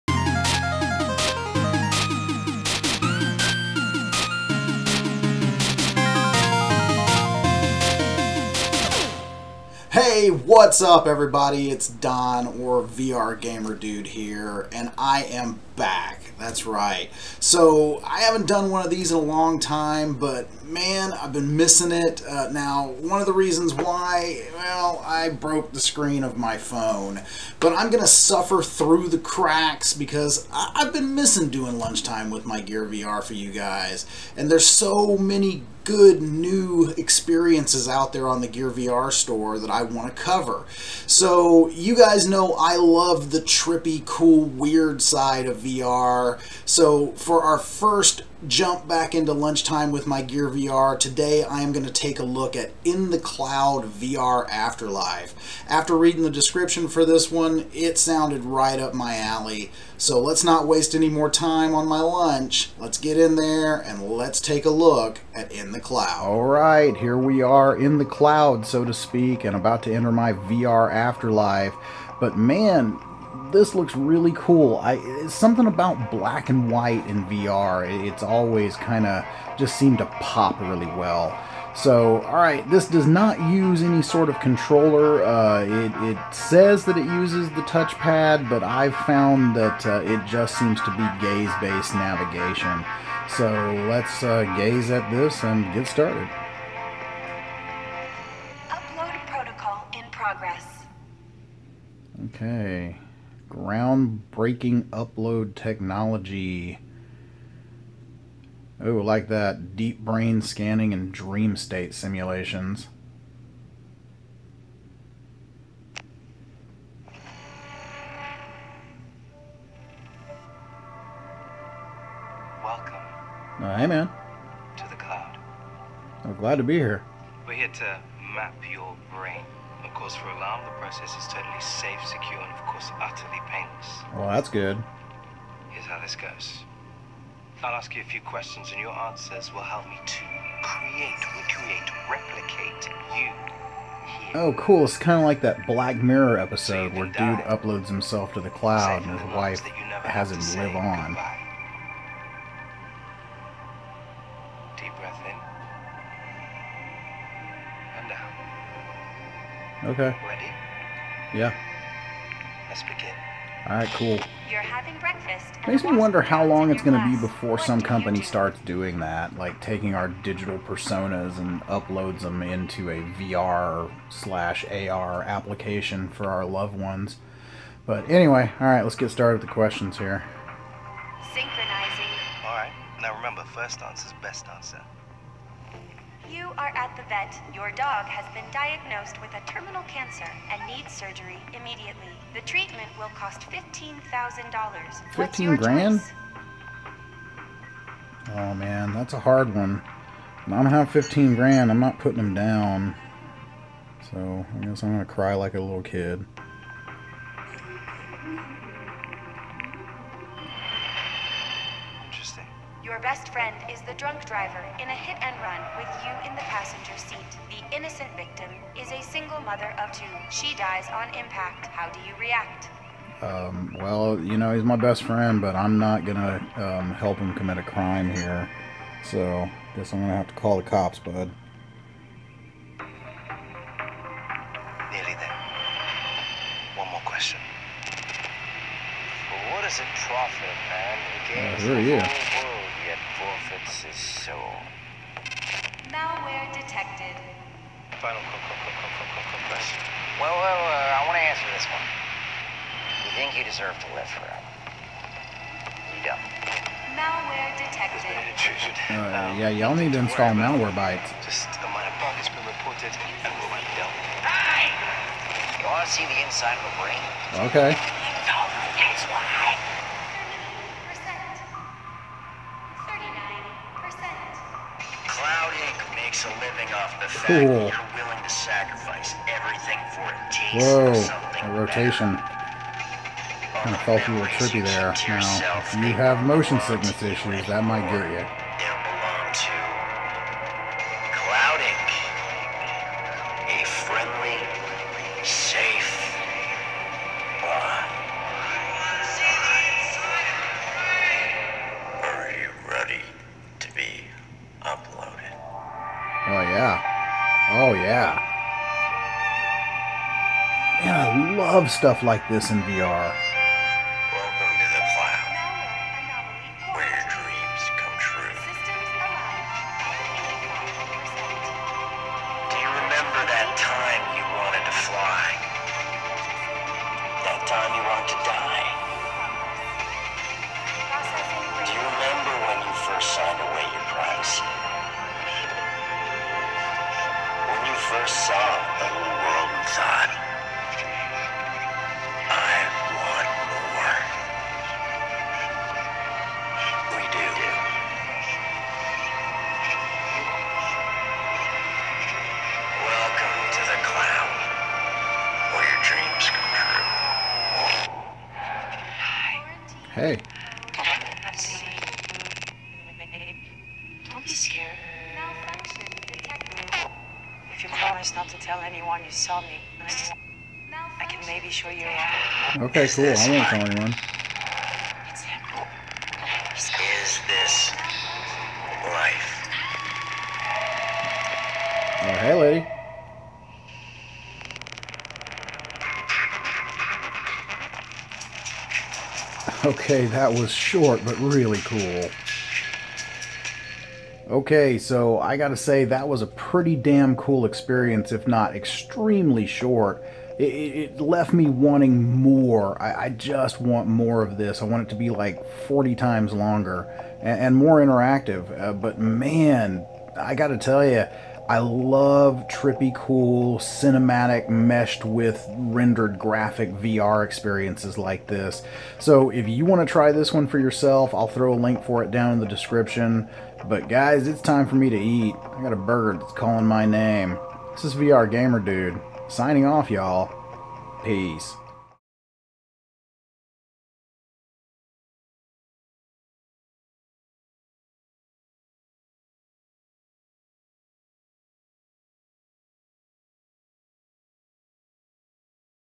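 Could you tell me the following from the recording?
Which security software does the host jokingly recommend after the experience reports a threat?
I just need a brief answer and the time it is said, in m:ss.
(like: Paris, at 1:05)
Malwarebytes, at 4:20.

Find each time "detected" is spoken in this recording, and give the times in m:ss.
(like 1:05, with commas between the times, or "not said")
4:06, 4:17.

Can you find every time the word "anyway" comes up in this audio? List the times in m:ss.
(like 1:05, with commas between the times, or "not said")
2:58.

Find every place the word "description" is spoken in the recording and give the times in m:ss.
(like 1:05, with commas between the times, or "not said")
0:56, 7:02.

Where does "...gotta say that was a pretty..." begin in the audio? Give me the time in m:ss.
6:35.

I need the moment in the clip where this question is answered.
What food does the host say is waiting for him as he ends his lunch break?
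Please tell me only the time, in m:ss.
7:05.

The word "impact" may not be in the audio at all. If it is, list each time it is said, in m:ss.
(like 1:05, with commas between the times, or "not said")
3:41.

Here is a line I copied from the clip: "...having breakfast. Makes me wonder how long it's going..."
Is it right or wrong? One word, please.
right.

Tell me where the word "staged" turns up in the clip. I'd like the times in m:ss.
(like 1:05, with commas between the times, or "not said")
not said.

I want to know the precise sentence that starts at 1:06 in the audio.
All right, here we are in the cloud, so to speak, and about to enter my VR Afterlife.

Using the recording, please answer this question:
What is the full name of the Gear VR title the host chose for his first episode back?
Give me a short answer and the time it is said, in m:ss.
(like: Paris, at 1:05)
In the Cloud VR Afterlife, at 0:52.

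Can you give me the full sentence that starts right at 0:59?
So let's not waste any more time on my lunch.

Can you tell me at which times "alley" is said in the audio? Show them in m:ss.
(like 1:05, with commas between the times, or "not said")
0:59.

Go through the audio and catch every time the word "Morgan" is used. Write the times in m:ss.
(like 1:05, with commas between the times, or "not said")
not said.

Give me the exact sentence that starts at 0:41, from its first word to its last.
So you guys know I love the trippy, cool, weird side of VR.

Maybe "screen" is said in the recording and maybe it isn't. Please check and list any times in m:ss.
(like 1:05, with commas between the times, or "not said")
0:25.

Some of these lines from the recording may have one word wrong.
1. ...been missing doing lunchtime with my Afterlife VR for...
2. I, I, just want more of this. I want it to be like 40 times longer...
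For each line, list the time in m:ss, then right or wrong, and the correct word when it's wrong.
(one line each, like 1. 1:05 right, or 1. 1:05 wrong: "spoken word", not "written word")
1. 0:30 wrong: "Gear", not "Afterlife"
2. 6:42 right.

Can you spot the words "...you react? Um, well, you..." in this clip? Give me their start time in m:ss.
3:42.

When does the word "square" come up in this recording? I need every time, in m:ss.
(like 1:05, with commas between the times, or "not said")
not said.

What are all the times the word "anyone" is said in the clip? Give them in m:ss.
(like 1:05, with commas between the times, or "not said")
6:08, 6:13.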